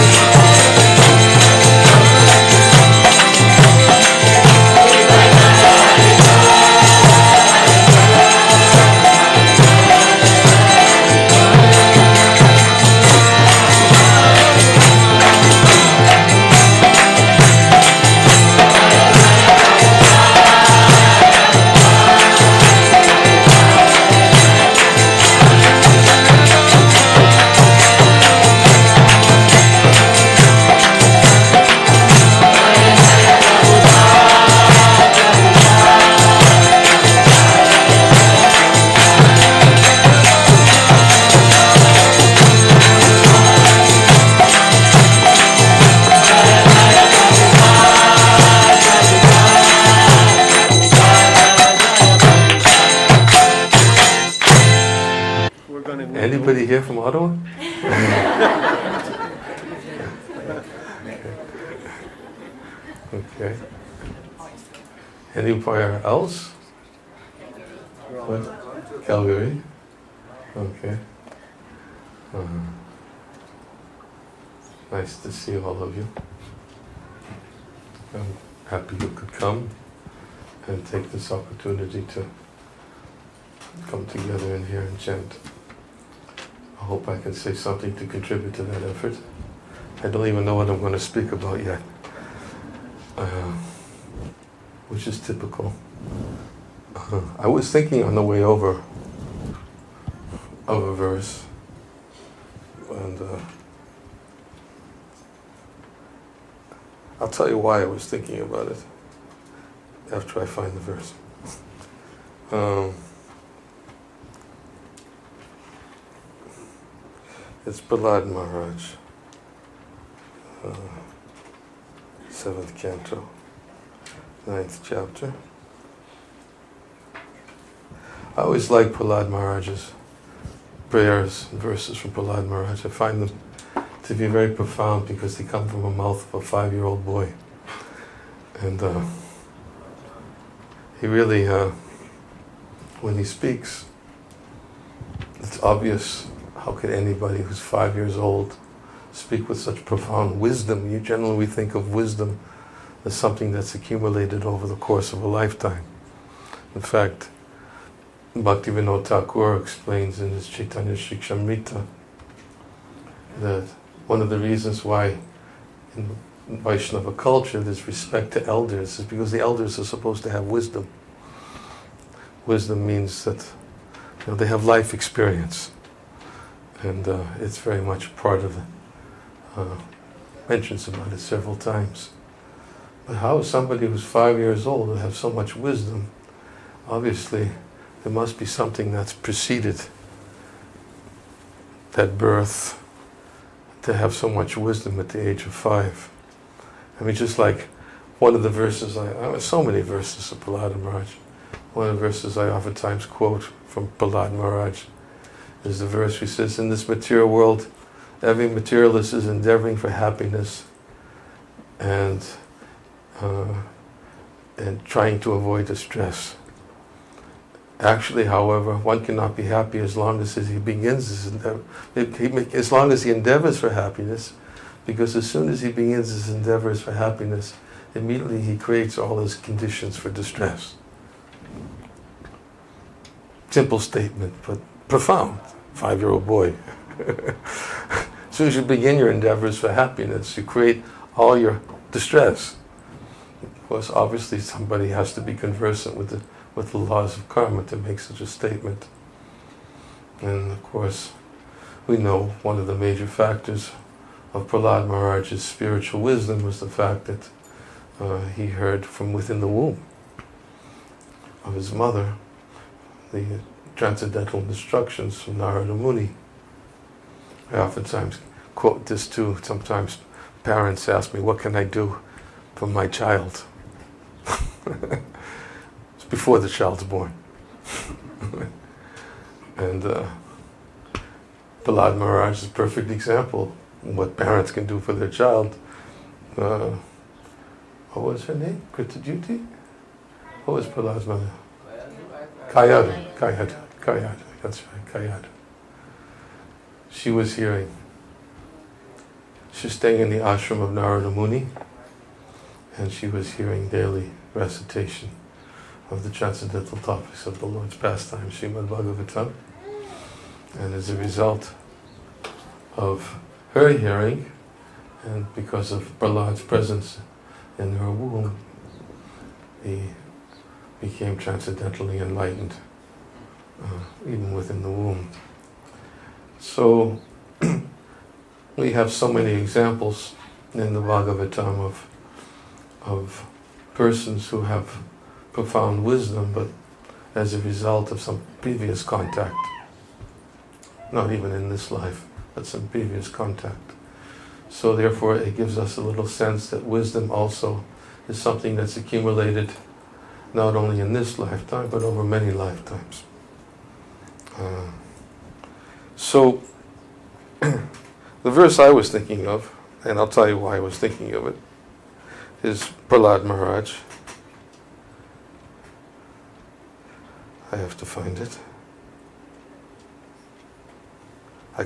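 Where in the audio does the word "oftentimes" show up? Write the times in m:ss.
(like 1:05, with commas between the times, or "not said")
3:22, 4:27.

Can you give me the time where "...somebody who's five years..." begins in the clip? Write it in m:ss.
3:03.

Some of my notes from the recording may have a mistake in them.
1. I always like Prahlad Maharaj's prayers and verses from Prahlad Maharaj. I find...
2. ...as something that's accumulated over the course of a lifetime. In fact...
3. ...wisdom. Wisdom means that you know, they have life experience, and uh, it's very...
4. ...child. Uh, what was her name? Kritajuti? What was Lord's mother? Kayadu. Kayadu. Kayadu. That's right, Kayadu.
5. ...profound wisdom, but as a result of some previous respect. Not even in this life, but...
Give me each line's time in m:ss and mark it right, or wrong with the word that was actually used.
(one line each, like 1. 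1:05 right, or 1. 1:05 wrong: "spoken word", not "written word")
1. 2:08 right
2. 2:33 right
3. 2:50 right
4. 4:45 wrong: "Prahlad", not "Lord"
5. 5:35 wrong: "contact", not "respect".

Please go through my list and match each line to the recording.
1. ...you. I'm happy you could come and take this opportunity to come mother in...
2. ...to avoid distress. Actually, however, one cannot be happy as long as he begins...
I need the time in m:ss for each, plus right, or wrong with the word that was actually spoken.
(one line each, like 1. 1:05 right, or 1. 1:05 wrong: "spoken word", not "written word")
1. 1:15 wrong: "together", not "mother"
2. 3:35 right.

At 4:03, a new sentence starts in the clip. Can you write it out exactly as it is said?
Of course, obviously, somebody has to be conversant with the with the laws of karma to make such a statement.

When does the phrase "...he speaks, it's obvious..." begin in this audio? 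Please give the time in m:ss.
2:23.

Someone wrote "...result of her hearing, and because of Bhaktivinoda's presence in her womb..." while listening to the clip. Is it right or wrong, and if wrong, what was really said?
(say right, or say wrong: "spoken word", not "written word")
wrong: "Prahlad", not "Bhaktivinoda".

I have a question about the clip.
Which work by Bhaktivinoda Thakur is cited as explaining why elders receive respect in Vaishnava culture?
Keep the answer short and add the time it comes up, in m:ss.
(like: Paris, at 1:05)
Chaitanya Shikshamrita, at 2:40.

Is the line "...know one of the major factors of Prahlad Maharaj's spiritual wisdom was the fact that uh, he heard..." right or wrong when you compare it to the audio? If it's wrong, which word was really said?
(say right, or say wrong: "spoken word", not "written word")
right.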